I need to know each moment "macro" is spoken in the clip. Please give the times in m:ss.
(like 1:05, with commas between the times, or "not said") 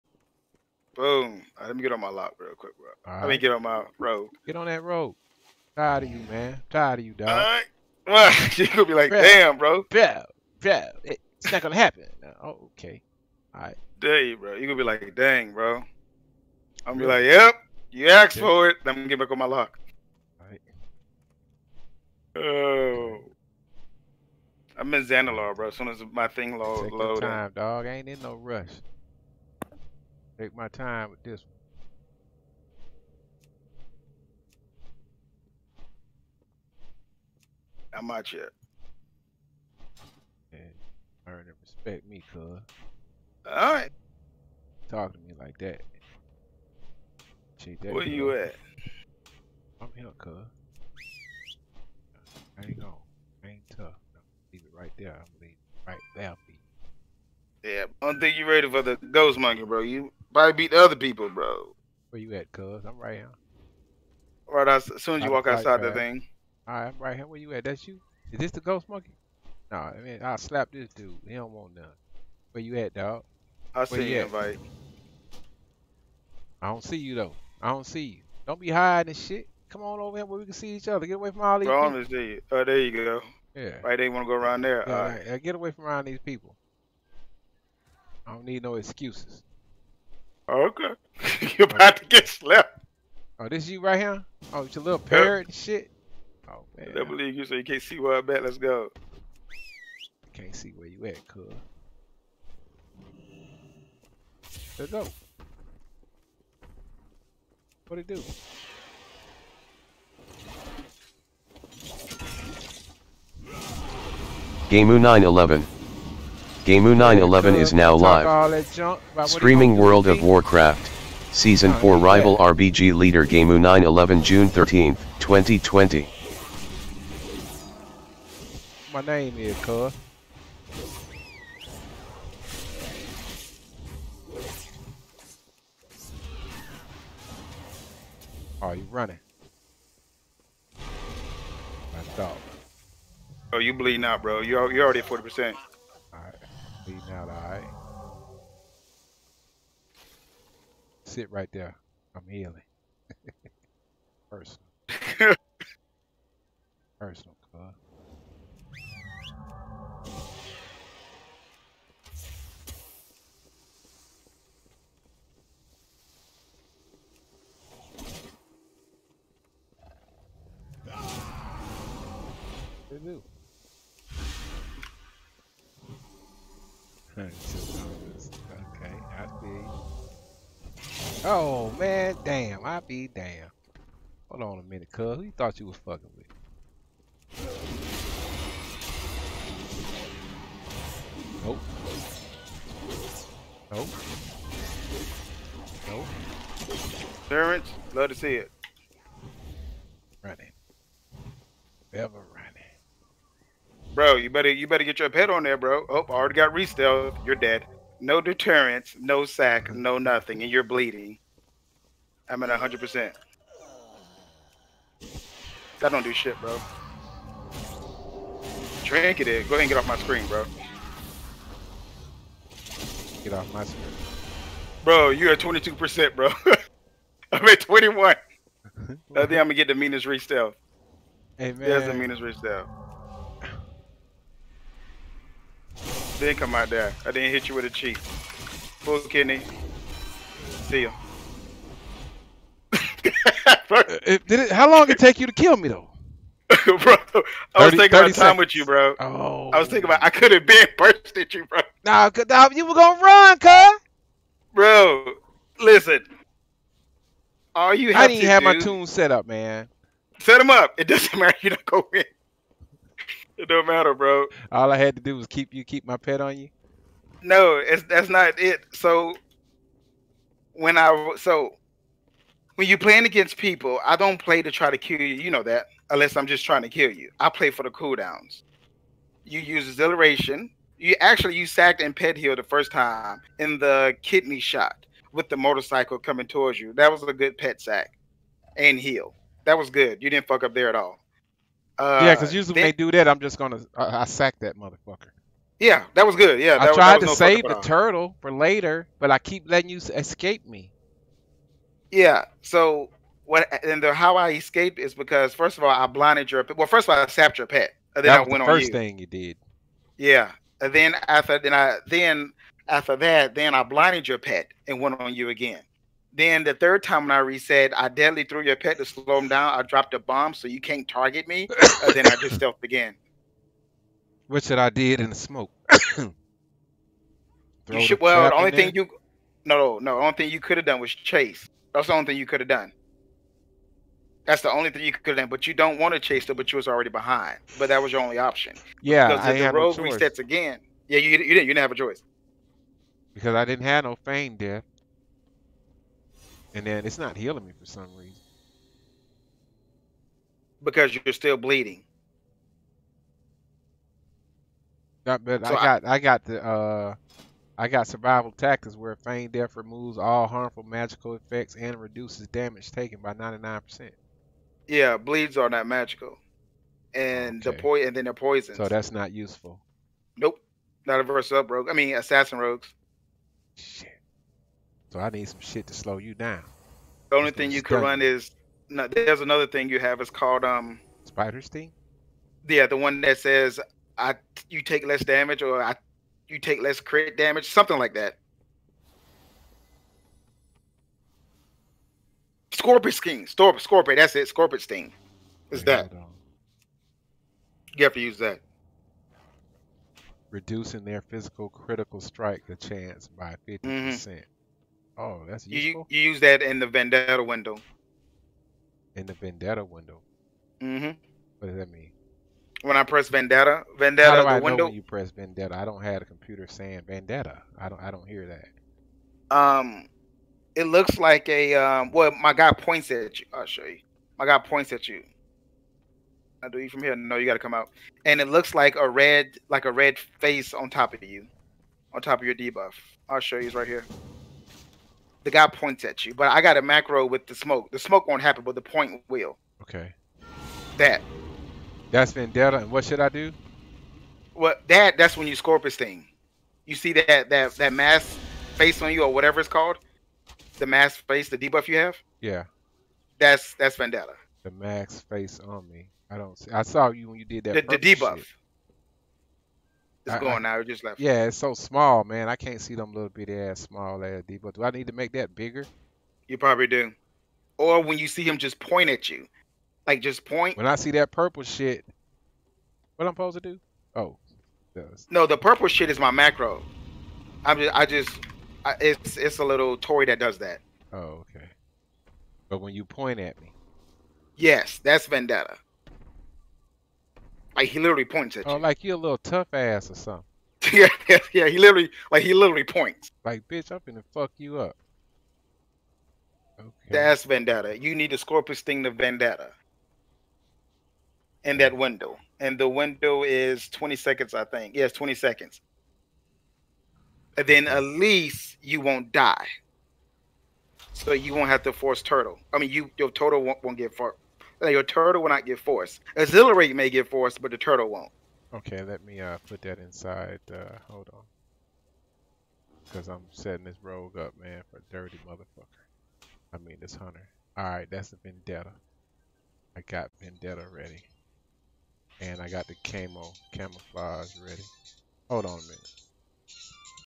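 7:16, 7:56.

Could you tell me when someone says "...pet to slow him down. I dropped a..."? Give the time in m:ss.
5:18.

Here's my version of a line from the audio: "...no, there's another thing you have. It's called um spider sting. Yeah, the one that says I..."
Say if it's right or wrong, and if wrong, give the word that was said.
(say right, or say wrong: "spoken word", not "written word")
right.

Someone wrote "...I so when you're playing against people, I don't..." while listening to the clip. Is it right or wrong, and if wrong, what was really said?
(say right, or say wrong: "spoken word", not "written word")
right.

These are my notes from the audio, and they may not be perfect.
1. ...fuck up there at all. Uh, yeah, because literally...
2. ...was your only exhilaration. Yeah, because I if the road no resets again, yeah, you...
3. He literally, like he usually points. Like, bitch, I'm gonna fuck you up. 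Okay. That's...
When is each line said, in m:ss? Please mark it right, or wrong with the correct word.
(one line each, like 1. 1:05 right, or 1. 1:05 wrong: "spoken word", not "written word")
1. 4:50 wrong: "usually", not "literally"
2. 5:37 wrong: "option", not "exhilaration"
3. 8:11 wrong: "literally", not "usually".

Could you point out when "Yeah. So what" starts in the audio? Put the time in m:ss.
5:01.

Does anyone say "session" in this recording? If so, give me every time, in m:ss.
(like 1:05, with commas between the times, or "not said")
not said.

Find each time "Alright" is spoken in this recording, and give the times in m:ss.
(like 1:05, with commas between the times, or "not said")
0:43, 1:06, 8:47.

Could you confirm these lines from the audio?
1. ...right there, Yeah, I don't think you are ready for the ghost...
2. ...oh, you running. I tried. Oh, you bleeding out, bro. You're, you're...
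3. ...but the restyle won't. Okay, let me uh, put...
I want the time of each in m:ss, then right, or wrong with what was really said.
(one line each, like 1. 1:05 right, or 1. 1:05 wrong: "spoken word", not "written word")
1. 0:55 right
2. 2:18 wrong: "stopped", not "tried"
3. 8:37 wrong: "turtle", not "restyle".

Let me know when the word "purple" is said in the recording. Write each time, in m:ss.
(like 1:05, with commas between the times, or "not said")
7:51, 7:55.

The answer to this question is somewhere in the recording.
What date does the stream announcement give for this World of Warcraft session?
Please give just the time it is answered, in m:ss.
2:04.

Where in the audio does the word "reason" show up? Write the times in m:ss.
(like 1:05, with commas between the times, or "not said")
5:47.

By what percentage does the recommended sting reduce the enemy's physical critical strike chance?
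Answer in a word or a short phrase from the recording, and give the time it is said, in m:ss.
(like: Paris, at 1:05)
50%, at 6:43.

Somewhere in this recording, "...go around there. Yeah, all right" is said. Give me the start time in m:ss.
1:24.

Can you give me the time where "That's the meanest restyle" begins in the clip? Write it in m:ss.
3:51.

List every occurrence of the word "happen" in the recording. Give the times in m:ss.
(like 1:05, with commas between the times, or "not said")
0:11, 7:18.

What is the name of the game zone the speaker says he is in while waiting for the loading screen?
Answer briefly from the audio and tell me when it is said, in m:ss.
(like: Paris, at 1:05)
Xanalar, at 0:25.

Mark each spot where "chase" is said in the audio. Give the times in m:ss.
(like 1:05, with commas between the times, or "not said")
5:30, 5:35.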